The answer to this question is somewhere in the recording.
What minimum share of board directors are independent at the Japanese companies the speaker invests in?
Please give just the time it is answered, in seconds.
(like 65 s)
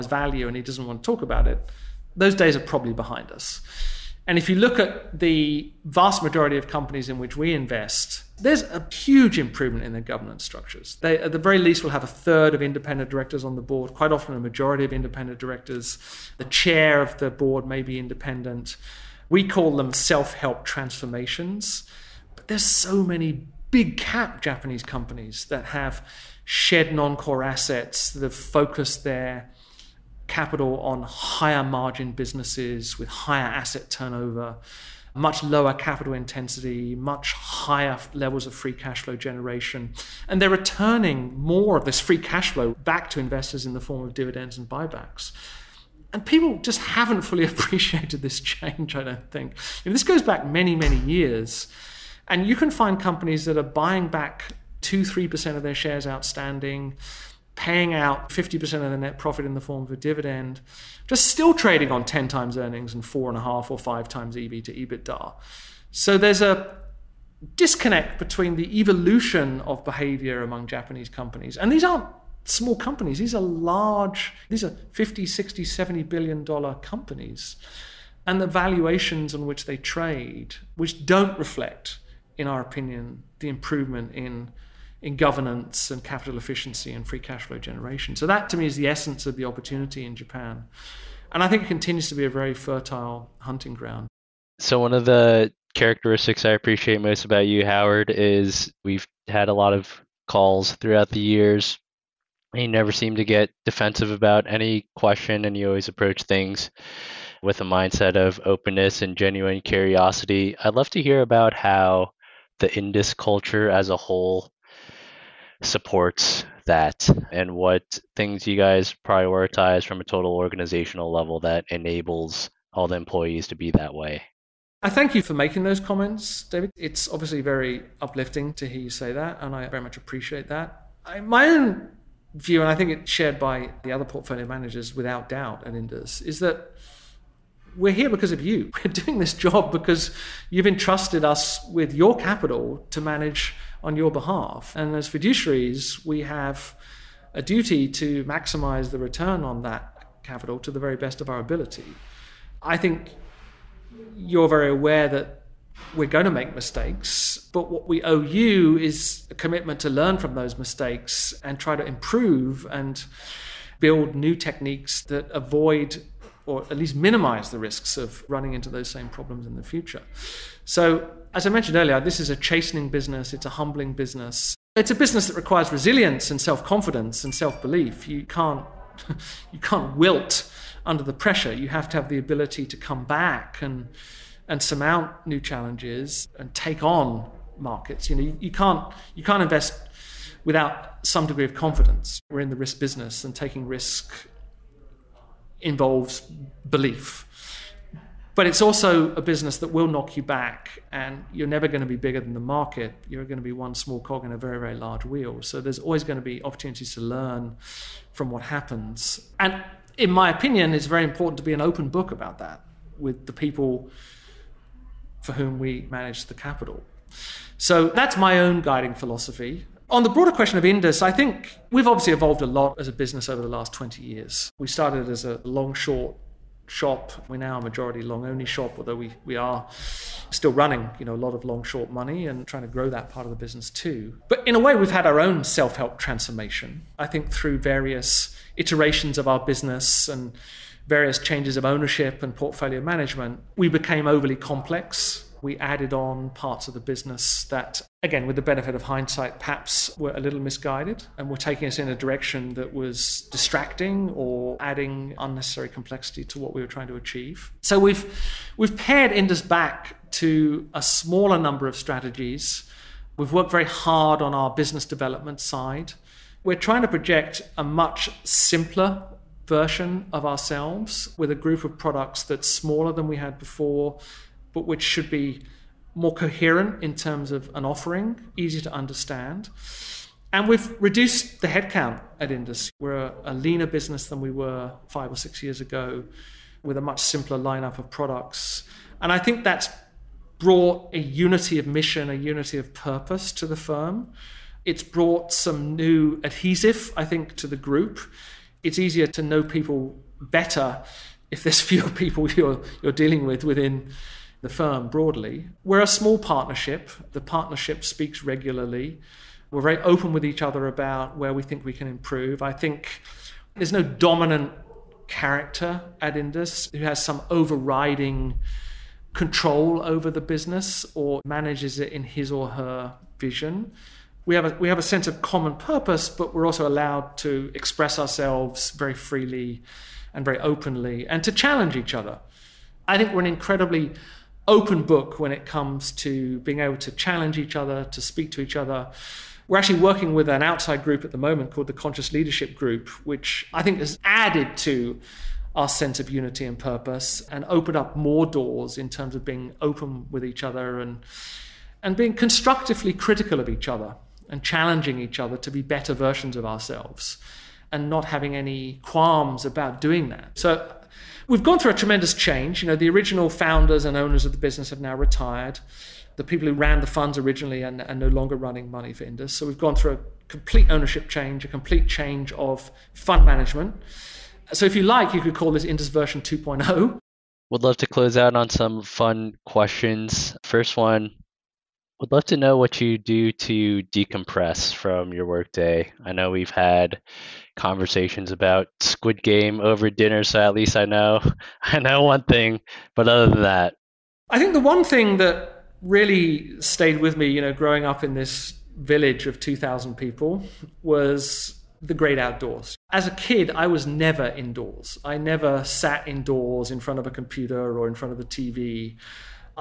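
12 s.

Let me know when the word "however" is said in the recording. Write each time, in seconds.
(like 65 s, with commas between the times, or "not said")
not said.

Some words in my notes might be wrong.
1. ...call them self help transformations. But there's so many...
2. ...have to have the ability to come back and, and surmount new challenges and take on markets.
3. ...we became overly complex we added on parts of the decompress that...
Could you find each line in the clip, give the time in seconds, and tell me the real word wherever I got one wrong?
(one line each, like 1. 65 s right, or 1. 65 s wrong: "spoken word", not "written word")
1. 19 s right
2. 181 s right
3. 243 s wrong: "business", not "decompress".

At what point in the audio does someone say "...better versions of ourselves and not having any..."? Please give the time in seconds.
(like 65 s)
355 s.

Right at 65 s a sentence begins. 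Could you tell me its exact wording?
So there's a disconnect between the evolution of behavior among Japanese companies.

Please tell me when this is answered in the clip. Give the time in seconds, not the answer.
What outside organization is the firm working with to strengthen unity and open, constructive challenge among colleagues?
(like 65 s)
341 s.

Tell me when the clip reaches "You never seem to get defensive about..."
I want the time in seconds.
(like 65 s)
102 s.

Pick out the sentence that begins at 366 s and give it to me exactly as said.
The people who ran the funds originally are no longer running money for Indus.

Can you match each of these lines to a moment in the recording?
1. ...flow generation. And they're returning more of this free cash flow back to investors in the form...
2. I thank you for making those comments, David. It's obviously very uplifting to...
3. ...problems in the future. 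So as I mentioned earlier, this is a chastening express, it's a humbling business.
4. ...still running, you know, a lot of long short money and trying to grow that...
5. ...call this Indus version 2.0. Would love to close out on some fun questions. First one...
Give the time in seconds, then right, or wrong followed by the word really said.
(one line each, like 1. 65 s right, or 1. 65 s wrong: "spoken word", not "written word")
1. 39 s right
2. 124 s right
3. 169 s wrong: "business", not "express"
4. 230 s right
5. 375 s right.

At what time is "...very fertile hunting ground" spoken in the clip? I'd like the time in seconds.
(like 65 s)
92 s.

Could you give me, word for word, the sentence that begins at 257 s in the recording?
So we've we've pared Indus back to a smaller number of strategies.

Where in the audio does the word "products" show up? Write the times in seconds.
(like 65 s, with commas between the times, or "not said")
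271 s, 287 s.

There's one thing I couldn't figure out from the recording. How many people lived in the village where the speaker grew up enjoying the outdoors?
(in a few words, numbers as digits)
2,000.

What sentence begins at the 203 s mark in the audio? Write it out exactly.
You're going to be one small cog in a very, very large wheel.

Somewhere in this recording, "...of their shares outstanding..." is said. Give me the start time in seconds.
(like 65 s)
55 s.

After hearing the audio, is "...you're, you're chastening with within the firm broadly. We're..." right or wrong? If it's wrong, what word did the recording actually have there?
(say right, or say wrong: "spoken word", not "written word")
wrong: "dealing", not "chastening".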